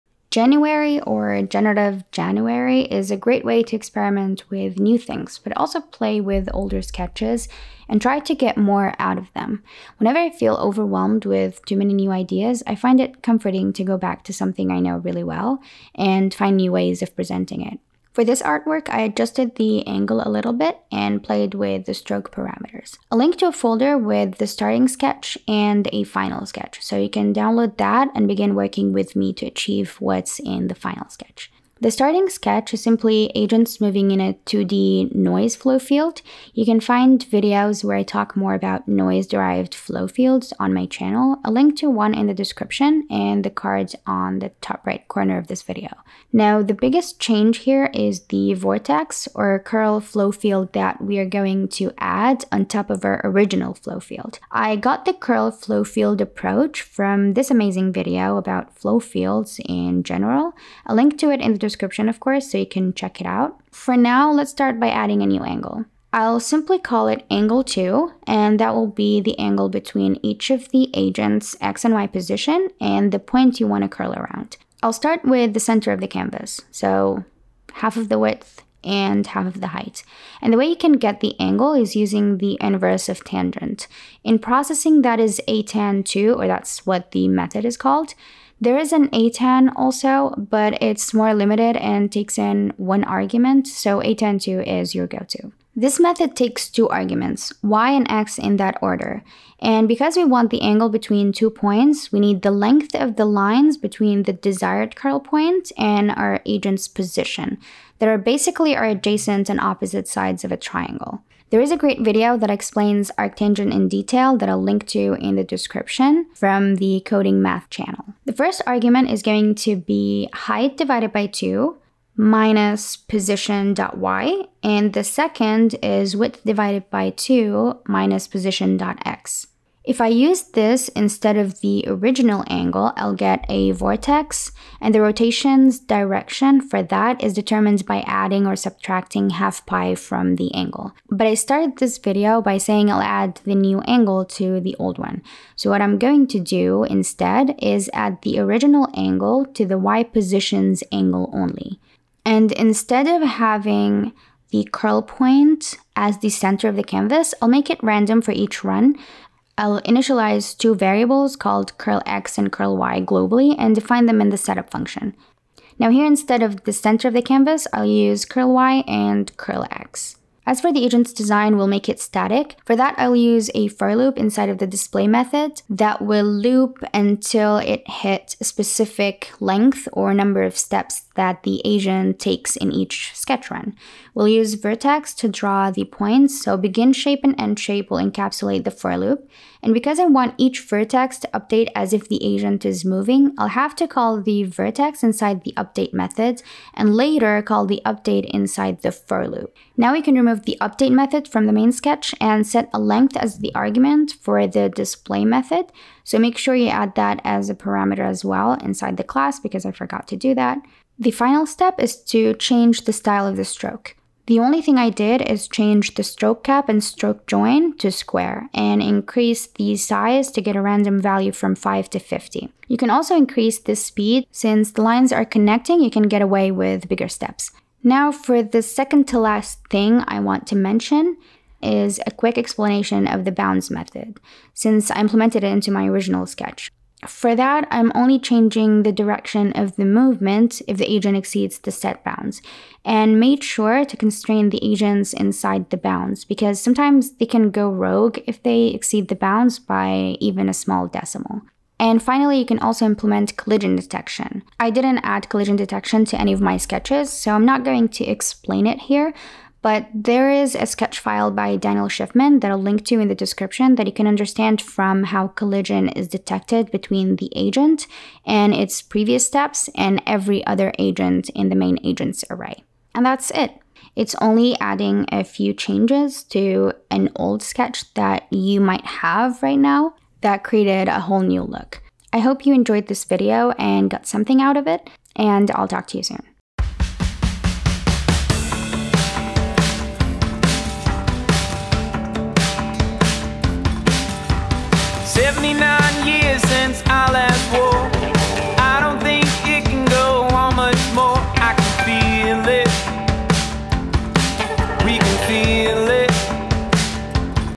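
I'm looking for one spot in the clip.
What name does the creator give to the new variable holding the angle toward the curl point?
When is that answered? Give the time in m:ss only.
1:07.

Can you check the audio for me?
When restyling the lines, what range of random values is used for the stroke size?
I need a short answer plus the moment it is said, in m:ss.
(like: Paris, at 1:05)
5 to 50, at 3:41.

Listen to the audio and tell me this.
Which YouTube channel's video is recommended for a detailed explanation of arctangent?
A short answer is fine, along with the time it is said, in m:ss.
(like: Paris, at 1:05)
Coding Math, at 1:57.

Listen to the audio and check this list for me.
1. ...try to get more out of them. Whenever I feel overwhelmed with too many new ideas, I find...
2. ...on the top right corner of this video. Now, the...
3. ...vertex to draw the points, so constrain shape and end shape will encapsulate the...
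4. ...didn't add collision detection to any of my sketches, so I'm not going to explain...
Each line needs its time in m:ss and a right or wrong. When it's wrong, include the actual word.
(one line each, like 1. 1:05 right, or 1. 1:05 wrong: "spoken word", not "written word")
1. 0:08 right
2. 0:44 right
3. 3:04 wrong: "begin", not "constrain"
4. 4:14 right.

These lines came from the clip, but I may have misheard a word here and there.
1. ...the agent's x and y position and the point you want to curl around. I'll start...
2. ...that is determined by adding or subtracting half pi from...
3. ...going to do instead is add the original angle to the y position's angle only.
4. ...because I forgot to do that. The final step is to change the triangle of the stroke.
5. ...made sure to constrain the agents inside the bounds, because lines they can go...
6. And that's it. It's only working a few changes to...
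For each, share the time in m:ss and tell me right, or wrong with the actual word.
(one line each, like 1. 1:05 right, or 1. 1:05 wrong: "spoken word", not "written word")
1. 1:10 right
2. 2:16 right
3. 2:25 right
4. 3:29 wrong: "style", not "triangle"
5. 4:03 wrong: "sometimes", not "lines"
6. 4:32 wrong: "adding", not "working".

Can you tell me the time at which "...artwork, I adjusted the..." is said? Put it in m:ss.
0:18.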